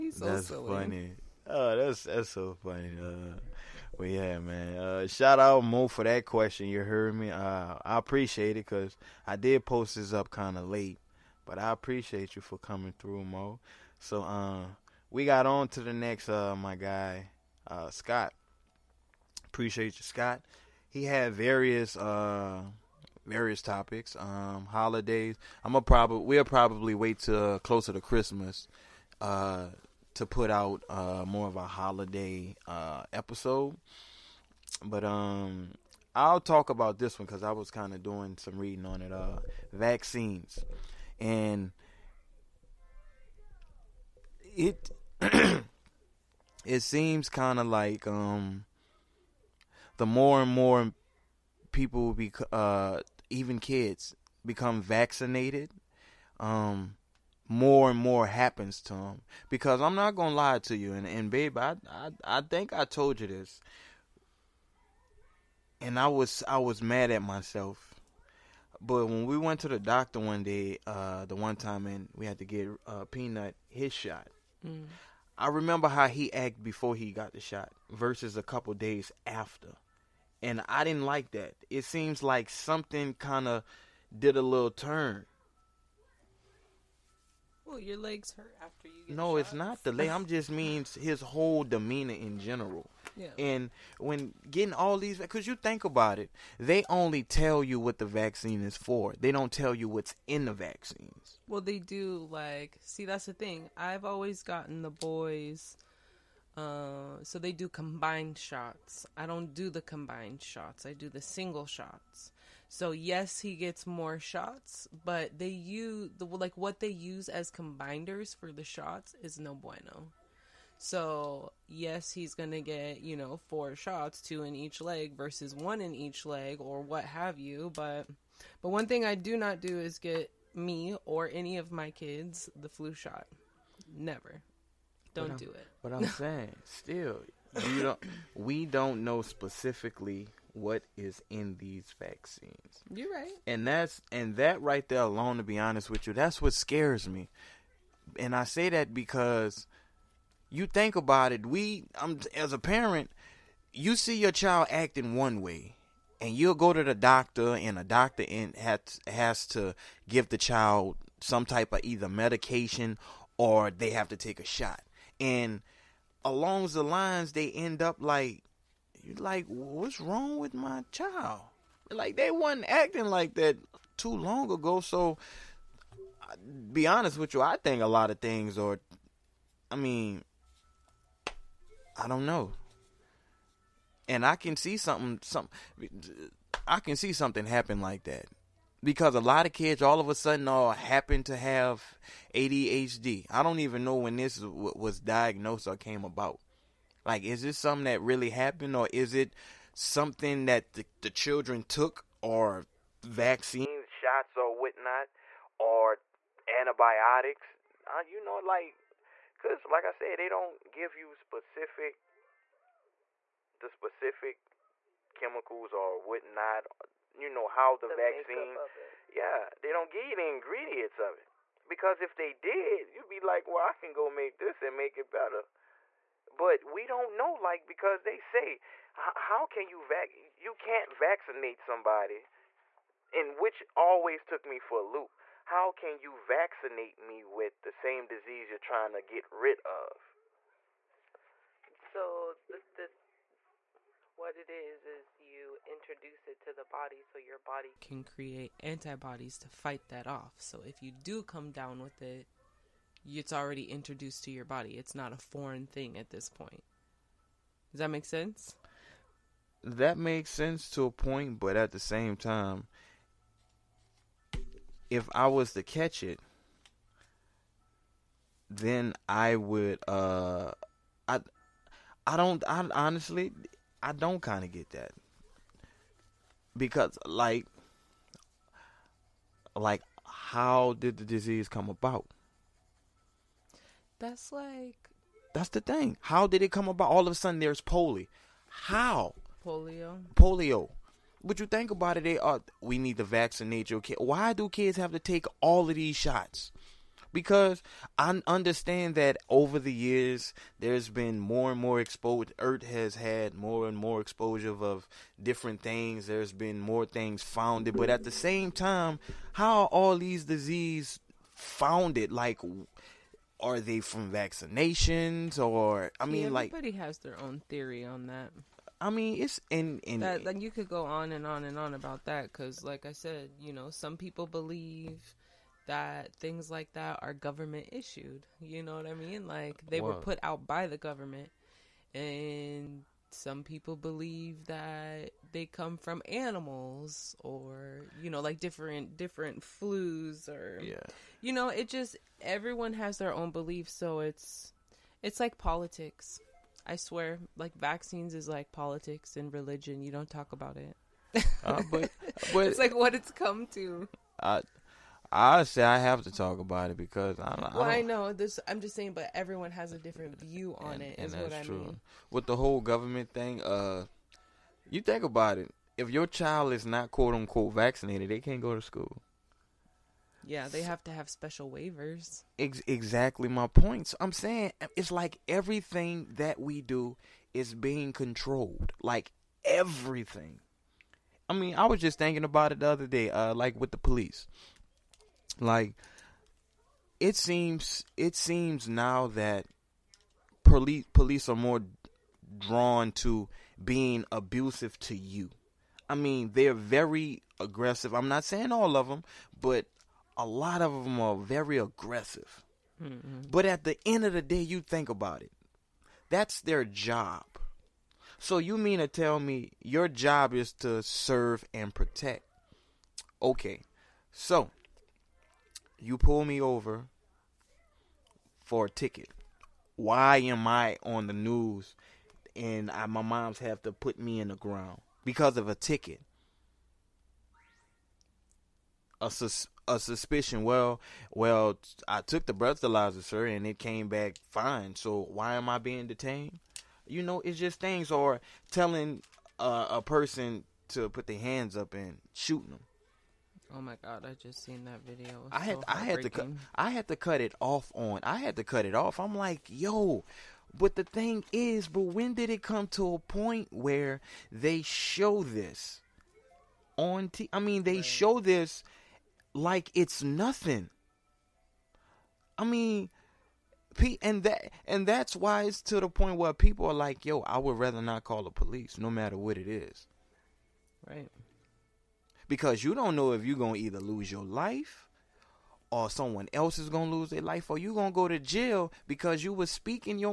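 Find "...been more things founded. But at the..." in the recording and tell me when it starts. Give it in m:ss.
5:06.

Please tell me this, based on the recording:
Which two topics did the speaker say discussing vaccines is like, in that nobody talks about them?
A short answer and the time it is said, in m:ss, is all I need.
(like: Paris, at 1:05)
Politics and religion, at 5:48.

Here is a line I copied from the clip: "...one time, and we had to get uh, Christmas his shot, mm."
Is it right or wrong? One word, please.
wrong.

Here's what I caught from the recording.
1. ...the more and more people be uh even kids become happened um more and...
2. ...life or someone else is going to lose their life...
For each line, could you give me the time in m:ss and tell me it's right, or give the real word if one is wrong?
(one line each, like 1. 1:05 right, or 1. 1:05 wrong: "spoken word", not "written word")
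1. 0:49 wrong: "vaccinated", not "happened"
2. 7:54 right.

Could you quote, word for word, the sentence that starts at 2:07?
But but one thing I do not do is get me or any of my kids the flu shot.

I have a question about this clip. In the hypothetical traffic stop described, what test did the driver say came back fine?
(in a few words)
Breathalyzer.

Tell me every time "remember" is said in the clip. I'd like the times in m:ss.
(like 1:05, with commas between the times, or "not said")
1:15.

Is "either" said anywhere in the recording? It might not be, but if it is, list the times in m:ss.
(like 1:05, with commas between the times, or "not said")
2:41, 7:53.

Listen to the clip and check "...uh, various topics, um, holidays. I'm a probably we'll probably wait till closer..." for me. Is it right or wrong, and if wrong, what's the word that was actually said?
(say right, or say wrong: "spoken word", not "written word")
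right.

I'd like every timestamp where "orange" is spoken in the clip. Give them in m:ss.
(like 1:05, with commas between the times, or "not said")
not said.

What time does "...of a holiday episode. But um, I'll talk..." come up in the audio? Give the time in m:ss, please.
0:31.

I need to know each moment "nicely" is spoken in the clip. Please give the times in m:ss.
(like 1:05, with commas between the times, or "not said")
not said.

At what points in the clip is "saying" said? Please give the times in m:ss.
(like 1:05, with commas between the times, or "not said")
2:16, 5:58, 6:14, 6:38.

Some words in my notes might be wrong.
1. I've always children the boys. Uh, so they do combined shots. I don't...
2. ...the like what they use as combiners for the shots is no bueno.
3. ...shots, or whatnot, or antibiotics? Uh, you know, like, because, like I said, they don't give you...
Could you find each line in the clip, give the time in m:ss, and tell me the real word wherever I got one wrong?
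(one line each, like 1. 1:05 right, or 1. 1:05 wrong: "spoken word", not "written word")
1. 1:43 wrong: "gotten", not "children"
2. 1:56 right
3. 3:23 right.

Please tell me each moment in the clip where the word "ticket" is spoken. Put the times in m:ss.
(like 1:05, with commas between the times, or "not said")
6:58, 7:05.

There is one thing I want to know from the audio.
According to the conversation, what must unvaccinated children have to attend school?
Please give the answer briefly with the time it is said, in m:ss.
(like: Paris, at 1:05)
Special waivers, at 6:11.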